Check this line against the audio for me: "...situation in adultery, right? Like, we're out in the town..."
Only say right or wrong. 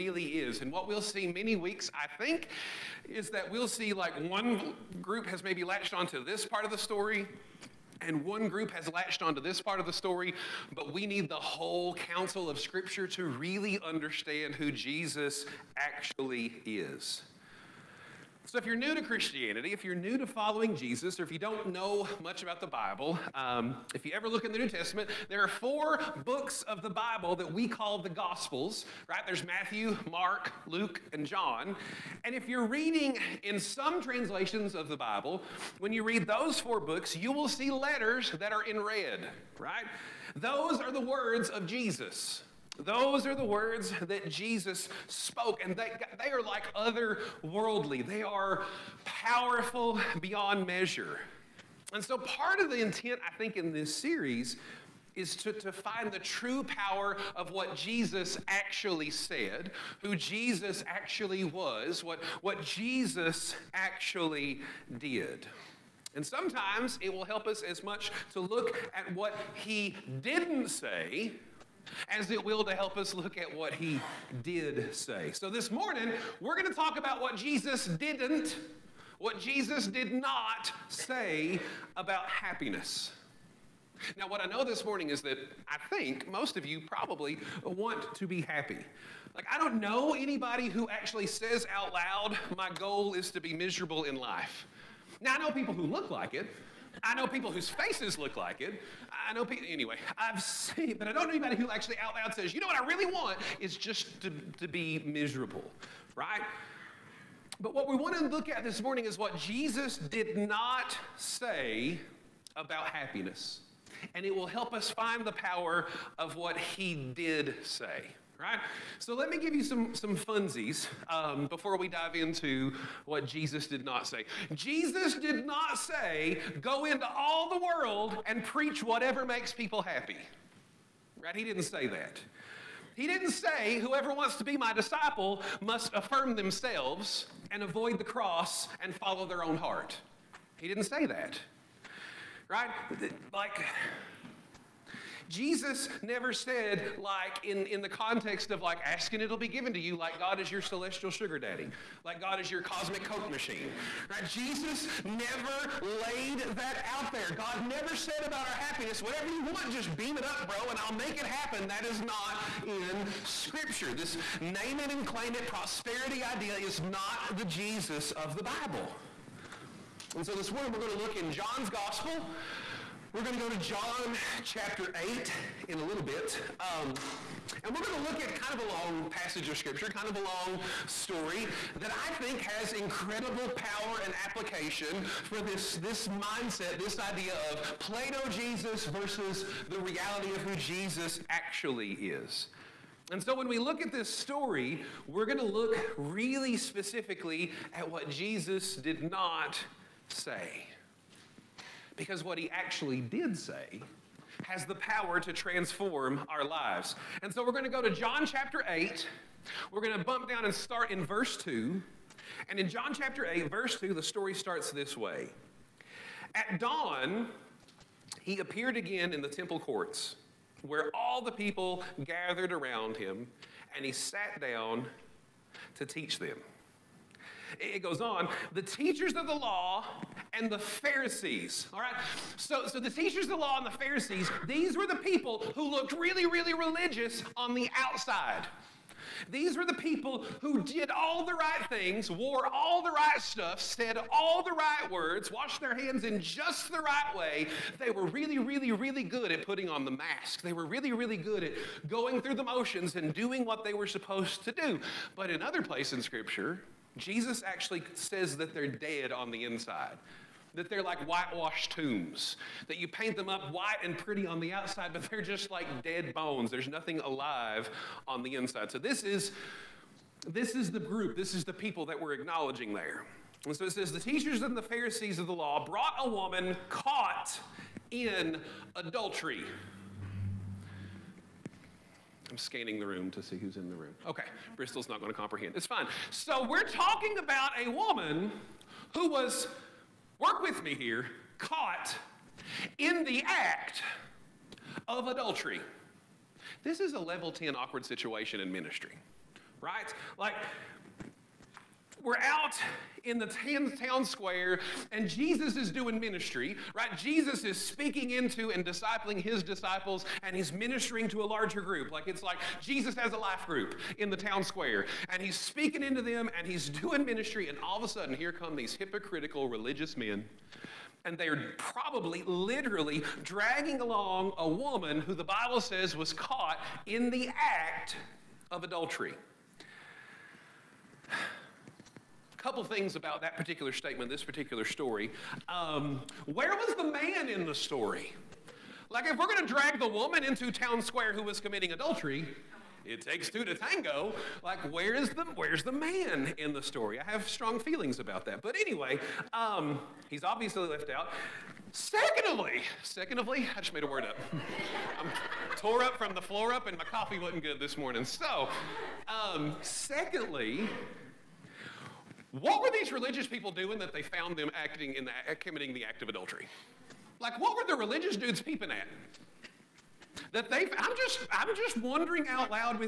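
wrong.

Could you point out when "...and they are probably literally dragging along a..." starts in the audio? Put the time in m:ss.
5:21.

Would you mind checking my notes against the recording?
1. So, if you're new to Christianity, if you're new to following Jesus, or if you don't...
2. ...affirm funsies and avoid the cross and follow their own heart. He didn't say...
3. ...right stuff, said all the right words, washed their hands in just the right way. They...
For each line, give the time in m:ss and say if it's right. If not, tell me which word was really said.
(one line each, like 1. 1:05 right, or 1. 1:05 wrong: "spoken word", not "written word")
1. 0:18 right
2. 2:15 wrong: "themselves", not "funsies"
3. 4:02 right.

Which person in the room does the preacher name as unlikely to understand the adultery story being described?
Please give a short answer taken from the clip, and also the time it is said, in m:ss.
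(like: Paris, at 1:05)
Bristol, at 4:44.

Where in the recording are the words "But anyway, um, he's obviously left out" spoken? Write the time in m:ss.
5:48.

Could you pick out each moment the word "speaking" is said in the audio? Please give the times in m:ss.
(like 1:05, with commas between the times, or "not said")
5:07, 5:15.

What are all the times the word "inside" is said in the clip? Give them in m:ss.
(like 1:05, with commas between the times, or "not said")
4:19, 4:28.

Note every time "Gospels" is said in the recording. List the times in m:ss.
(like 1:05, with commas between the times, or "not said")
0:28, 2:51.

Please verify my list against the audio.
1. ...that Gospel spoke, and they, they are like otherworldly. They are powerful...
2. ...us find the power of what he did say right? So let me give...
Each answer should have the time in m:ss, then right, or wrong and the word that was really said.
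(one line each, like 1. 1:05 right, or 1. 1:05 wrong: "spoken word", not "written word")
1. 0:44 wrong: "Jesus", not "Gospel"
2. 1:54 right.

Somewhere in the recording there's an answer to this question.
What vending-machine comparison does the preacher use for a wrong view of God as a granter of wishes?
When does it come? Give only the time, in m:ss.
2:32.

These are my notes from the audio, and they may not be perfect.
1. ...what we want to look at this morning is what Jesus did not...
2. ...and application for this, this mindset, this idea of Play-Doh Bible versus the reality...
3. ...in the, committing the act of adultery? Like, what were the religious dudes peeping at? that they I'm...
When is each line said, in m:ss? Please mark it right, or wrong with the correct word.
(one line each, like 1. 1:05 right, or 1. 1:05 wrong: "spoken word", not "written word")
1. 1:47 right
2. 3:04 wrong: "Jesus", not "Bible"
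3. 6:04 right.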